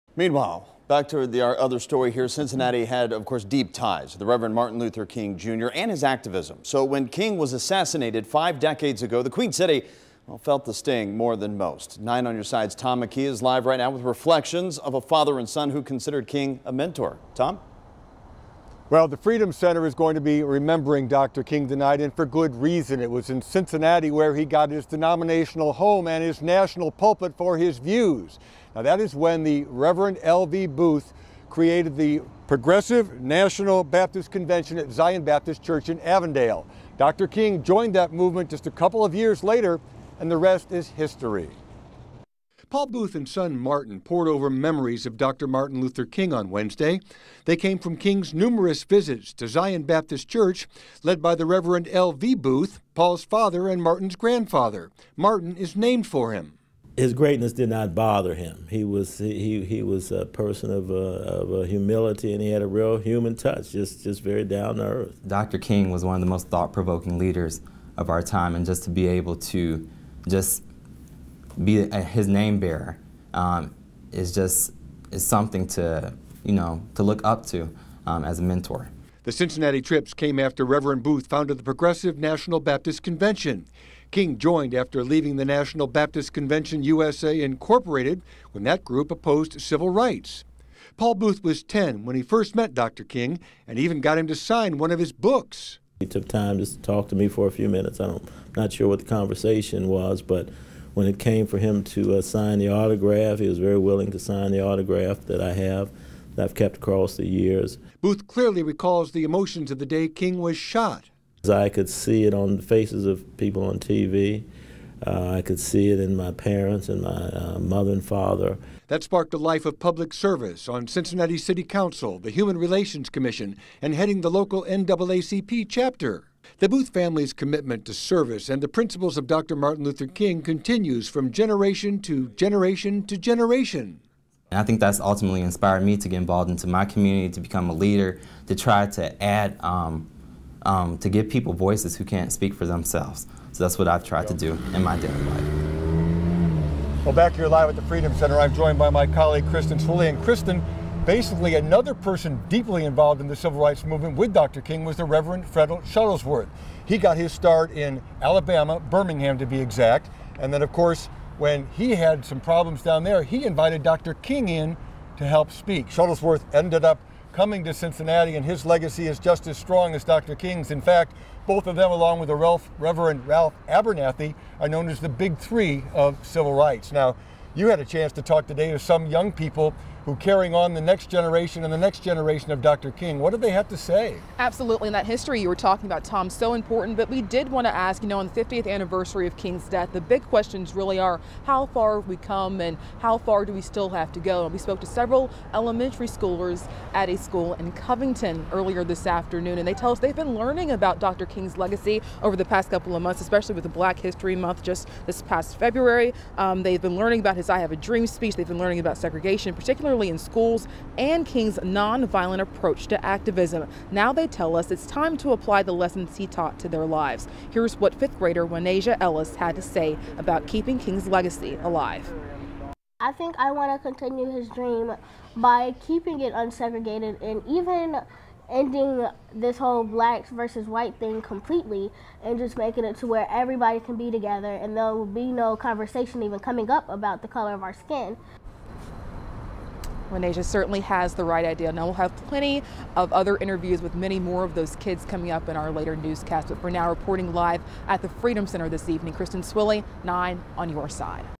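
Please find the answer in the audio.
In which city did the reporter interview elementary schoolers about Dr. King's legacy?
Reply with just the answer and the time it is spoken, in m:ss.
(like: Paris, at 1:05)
Covington, at 3:17.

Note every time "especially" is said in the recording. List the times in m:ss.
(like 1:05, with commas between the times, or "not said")
3:23.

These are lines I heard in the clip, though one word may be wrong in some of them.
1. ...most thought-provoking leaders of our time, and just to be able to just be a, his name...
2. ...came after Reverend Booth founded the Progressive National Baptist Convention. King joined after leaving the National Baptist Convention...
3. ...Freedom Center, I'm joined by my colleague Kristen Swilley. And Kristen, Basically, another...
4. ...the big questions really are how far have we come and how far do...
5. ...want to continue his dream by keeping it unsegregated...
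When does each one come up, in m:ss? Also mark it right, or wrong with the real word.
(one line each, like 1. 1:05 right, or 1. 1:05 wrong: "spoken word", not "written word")
1. 1:06 right
2. 1:20 right
3. 2:27 right
4. 3:09 right
5. 3:43 right.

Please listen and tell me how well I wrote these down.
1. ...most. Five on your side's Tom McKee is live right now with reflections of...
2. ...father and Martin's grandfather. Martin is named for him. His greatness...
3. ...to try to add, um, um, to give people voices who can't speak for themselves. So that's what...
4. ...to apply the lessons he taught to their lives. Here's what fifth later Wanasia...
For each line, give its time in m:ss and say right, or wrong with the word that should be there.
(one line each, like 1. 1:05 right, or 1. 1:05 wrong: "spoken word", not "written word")
1. 0:11 wrong: "Nine", not "Five"
2. 0:53 right
3. 2:18 right
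4. 3:35 wrong: "grader", not "later".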